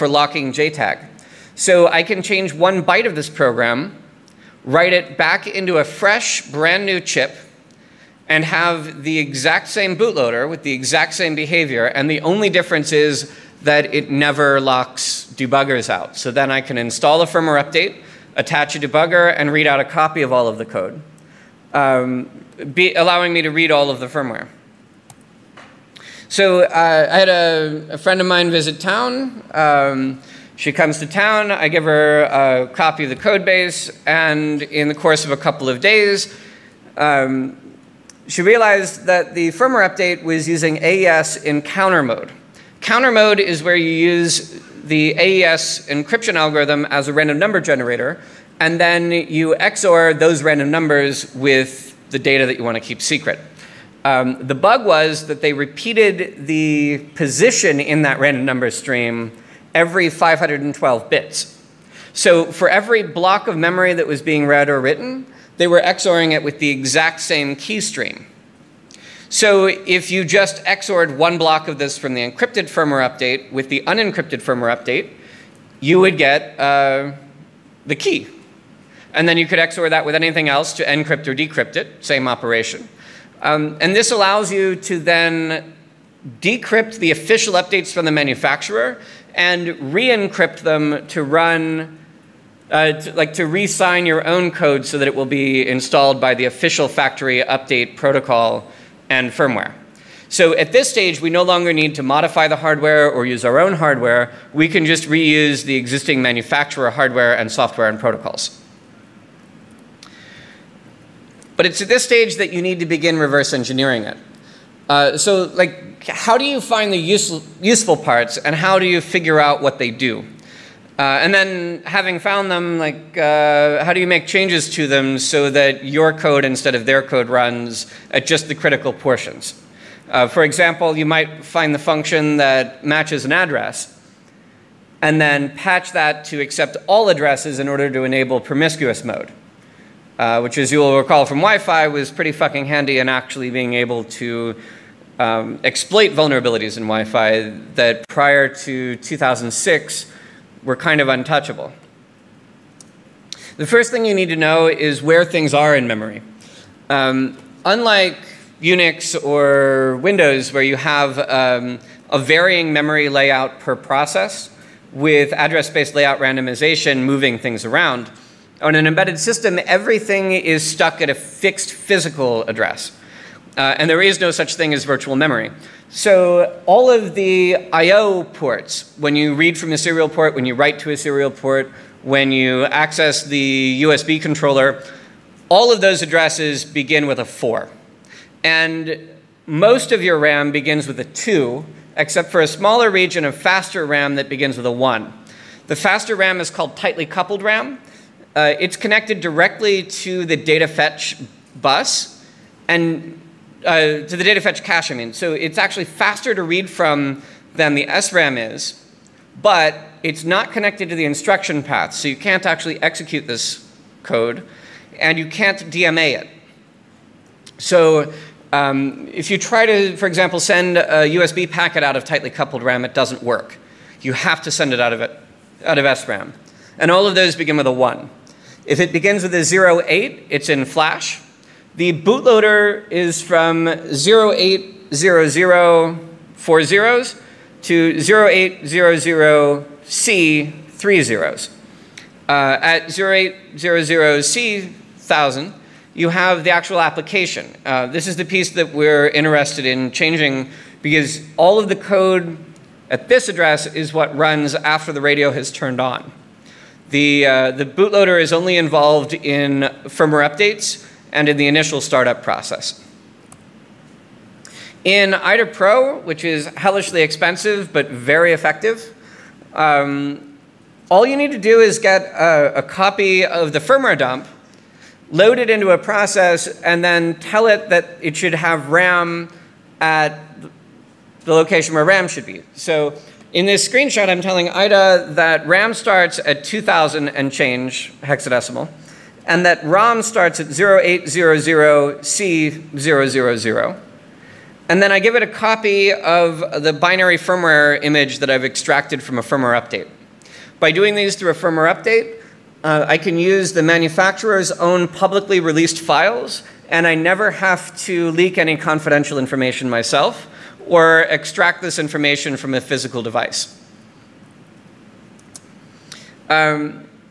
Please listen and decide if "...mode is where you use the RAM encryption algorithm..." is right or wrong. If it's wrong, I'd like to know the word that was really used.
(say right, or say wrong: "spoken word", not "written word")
wrong: "AES", not "RAM".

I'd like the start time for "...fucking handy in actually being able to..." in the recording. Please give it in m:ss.
2:22.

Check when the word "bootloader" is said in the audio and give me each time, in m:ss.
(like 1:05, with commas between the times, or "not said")
0:09, 3:52, 4:17.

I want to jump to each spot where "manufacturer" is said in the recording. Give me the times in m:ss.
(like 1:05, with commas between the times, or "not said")
1:28, 1:46, 5:03.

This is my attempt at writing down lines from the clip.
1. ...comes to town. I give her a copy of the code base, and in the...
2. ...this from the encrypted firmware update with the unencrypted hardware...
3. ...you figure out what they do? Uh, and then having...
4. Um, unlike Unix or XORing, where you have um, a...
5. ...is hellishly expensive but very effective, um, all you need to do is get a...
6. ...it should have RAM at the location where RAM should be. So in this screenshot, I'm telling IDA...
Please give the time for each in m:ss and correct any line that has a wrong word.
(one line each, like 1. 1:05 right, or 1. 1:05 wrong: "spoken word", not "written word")
1. 0:30 right
2. 1:11 wrong: "firmware", not "hardware"
3. 1:58 right
4. 2:36 wrong: "Windows", not "XORing"
5. 4:26 right
6. 4:38 right.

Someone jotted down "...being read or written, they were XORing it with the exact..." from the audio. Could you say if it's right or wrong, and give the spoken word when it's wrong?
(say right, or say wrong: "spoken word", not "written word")
right.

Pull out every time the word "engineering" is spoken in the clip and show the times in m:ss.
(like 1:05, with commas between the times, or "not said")
1:53.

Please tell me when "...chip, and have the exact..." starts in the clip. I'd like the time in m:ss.
0:07.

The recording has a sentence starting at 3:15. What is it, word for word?
The faster RAM is called tightly coupled RAM.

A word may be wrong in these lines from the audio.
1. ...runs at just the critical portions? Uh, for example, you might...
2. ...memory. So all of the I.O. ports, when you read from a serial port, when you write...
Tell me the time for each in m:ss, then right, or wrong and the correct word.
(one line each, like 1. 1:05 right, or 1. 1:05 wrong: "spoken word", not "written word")
1. 2:07 right
2. 2:55 right.